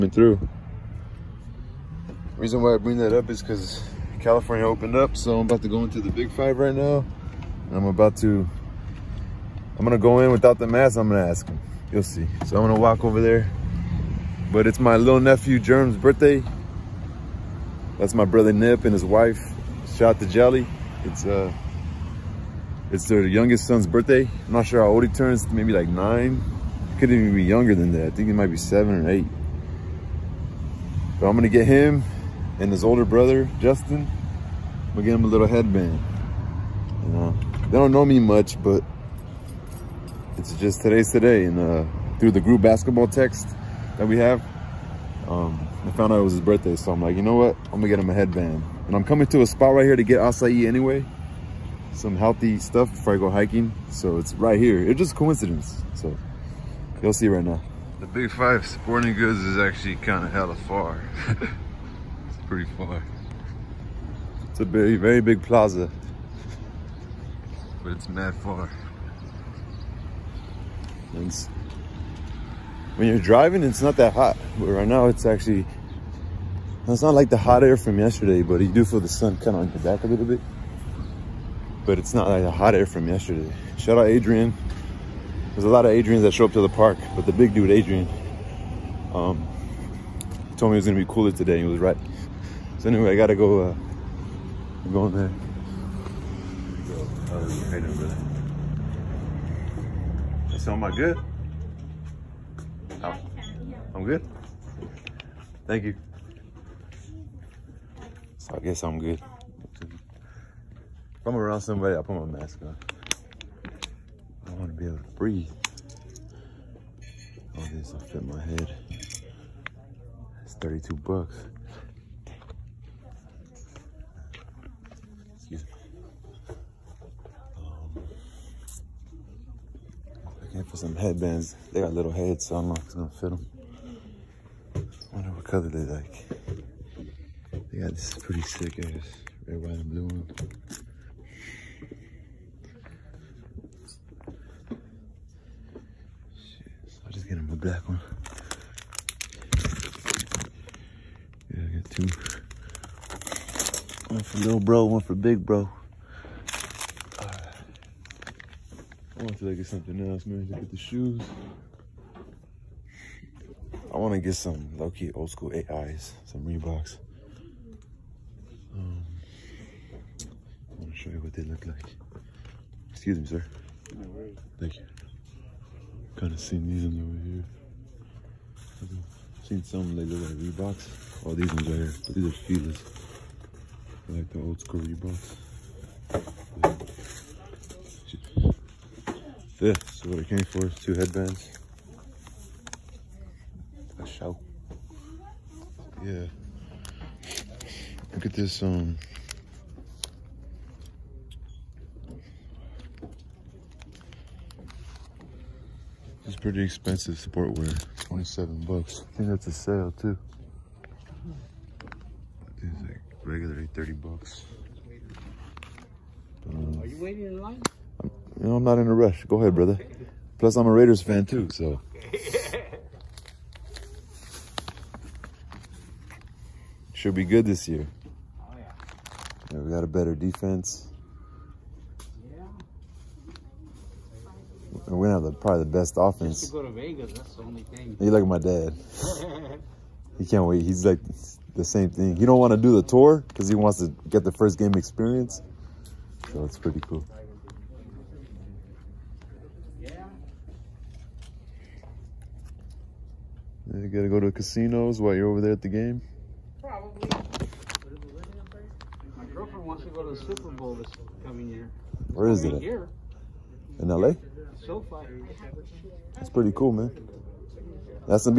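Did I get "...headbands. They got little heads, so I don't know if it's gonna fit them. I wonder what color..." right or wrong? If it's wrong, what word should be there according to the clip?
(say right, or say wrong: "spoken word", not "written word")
right.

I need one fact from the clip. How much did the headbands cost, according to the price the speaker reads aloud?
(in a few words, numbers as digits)
$32.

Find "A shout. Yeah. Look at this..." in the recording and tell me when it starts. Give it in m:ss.
3:14.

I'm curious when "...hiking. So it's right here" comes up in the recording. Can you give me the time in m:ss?
0:53.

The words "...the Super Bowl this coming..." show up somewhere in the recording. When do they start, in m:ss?
4:20.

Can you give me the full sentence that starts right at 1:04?
It's a very, very big plaza.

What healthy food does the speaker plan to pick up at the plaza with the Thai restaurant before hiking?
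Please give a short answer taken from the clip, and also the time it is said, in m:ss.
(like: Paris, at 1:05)
acai, at 0:50.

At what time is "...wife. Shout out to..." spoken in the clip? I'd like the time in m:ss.
0:19.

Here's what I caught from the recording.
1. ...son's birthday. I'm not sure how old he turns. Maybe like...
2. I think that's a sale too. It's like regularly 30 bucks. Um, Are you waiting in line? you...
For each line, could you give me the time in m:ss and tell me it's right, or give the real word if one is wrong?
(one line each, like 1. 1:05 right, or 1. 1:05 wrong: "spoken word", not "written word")
1. 0:23 right
2. 3:29 right.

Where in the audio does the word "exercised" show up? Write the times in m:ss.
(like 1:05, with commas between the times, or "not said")
not said.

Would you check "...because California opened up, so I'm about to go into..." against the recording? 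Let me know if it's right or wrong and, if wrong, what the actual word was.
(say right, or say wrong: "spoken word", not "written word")
right.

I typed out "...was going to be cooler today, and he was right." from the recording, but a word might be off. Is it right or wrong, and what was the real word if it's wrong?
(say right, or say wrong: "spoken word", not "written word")
right.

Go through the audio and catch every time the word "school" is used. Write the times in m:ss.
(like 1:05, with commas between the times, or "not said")
2:45, 3:04.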